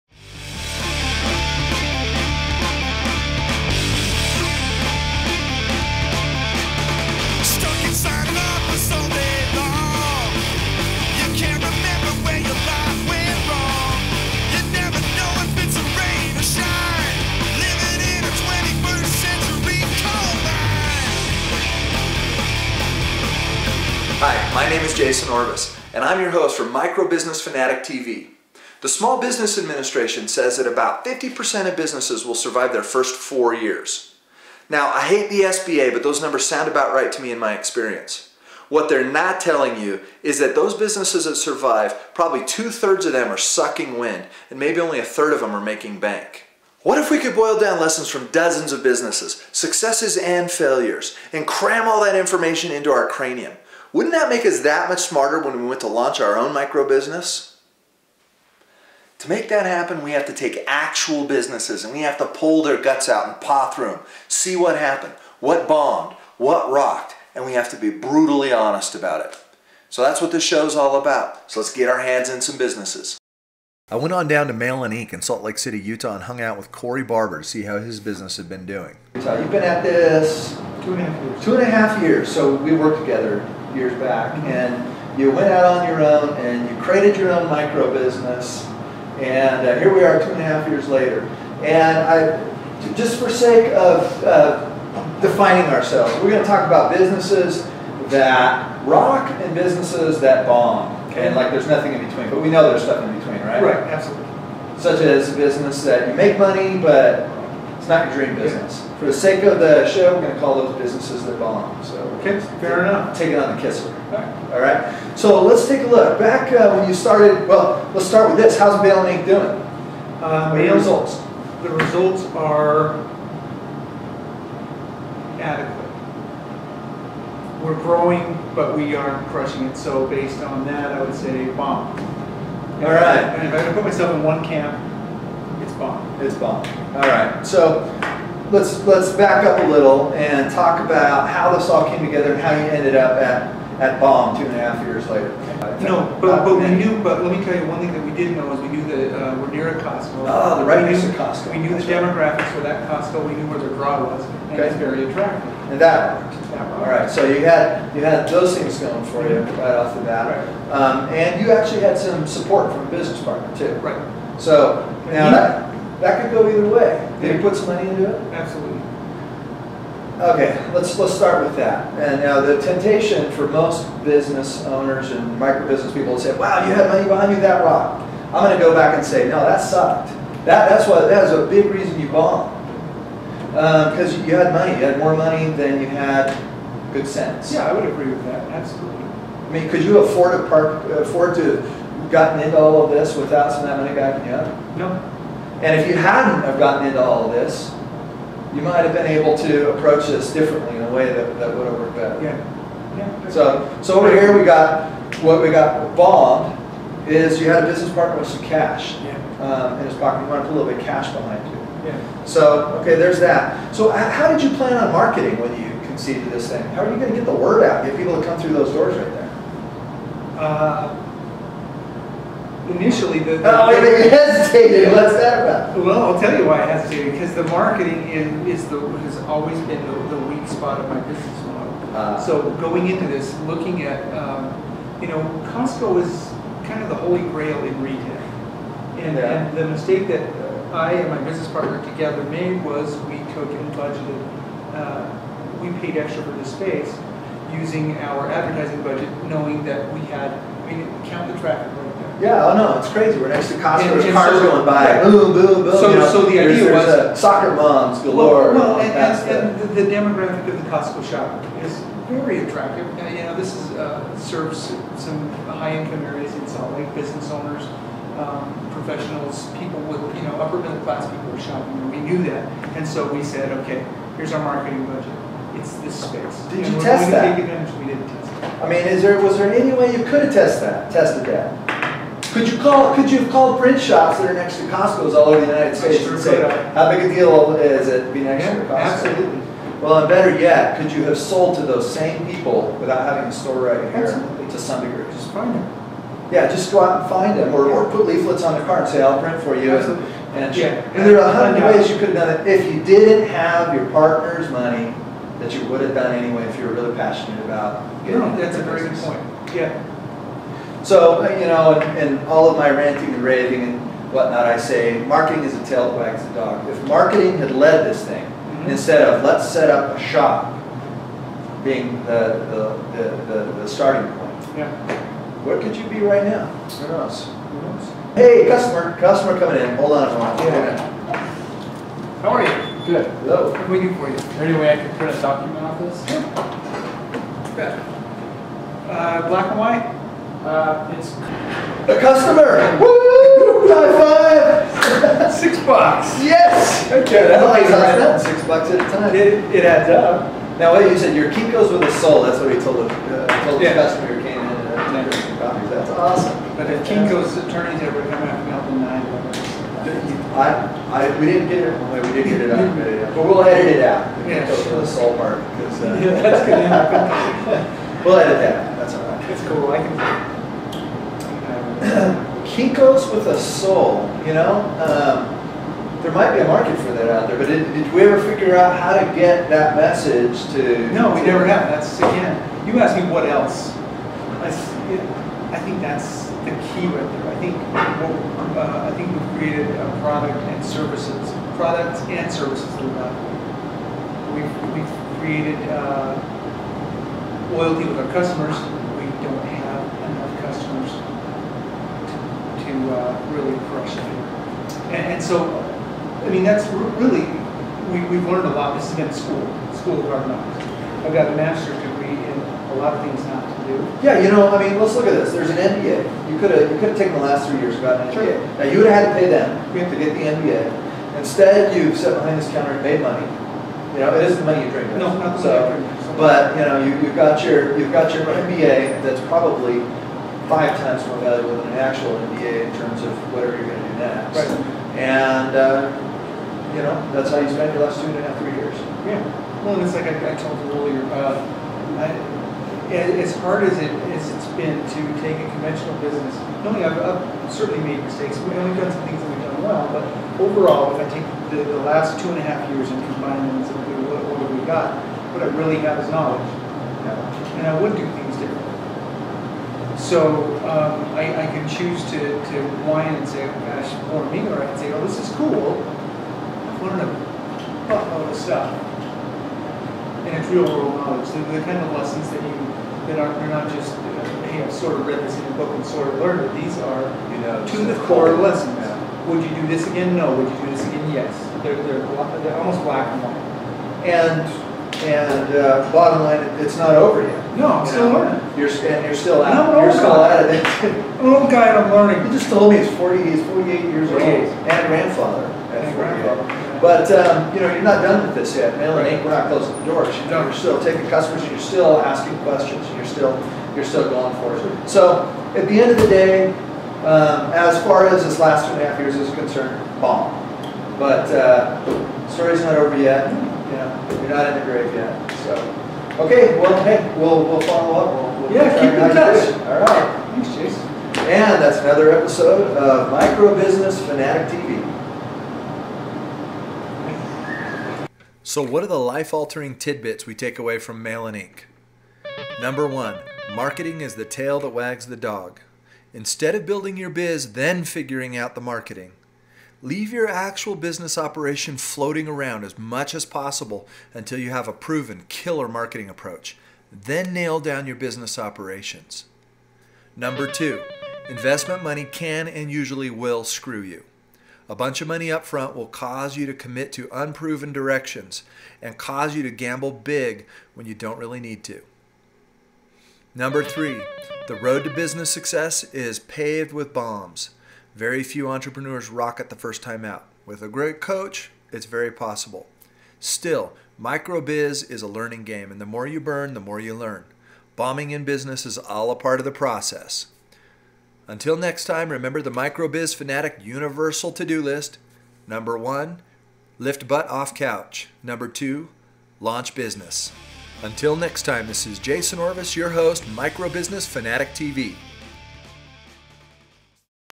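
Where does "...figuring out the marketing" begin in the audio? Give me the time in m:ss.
8:57.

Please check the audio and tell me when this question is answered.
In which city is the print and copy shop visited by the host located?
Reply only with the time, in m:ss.
1:15.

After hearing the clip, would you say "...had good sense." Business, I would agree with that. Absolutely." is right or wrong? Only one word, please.
wrong.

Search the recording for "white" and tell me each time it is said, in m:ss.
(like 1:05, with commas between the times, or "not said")
5:39, 8:03.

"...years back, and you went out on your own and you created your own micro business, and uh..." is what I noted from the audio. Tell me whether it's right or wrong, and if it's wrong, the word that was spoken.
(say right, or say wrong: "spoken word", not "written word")
right.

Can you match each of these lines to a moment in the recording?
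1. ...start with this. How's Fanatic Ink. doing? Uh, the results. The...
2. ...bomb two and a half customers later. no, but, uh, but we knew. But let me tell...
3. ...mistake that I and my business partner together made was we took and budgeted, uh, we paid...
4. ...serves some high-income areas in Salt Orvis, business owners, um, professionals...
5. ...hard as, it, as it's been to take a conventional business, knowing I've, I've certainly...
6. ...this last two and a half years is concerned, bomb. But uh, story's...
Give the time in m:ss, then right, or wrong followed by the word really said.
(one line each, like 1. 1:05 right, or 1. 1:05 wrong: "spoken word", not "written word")
1. 1:58 wrong: "Mail", not "Fanatic"
2. 2:23 wrong: "years", not "customers"
3. 3:59 right
4. 4:24 wrong: "Lake", not "Orvis"
5. 7:23 right
6. 8:28 right.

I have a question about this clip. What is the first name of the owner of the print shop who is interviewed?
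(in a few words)
Cory.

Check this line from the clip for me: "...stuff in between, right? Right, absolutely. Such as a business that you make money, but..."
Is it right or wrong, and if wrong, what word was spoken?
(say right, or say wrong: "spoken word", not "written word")
right.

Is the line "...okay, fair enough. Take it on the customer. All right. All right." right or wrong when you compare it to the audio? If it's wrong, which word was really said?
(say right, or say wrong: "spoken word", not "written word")
wrong: "kisser", not "customer".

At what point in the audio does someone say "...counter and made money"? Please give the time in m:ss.
7:02.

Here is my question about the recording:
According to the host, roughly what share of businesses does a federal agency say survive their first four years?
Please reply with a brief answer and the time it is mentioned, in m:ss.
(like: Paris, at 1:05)
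50%, at 0:31.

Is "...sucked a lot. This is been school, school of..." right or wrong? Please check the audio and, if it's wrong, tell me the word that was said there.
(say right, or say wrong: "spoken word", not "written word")
wrong: "learned", not "sucked".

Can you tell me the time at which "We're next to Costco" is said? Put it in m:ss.
4:13.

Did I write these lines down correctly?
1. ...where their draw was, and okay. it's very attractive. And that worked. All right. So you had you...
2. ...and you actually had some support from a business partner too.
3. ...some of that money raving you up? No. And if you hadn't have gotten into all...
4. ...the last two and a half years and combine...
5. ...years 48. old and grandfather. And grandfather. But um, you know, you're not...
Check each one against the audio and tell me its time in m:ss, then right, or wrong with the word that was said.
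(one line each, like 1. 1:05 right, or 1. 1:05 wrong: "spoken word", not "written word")
1. 2:33 right
2. 2:41 right
3. 3:13 wrong: "backing", not "raving"
4. 7:31 right
5. 8:13 right.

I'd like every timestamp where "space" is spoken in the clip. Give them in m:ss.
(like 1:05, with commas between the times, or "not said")
4:06, 4:36.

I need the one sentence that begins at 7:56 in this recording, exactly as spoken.
These are you know, to the core lessons.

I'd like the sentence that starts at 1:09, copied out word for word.
So that's what this show's all about.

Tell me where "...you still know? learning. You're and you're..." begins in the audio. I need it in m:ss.
8:07.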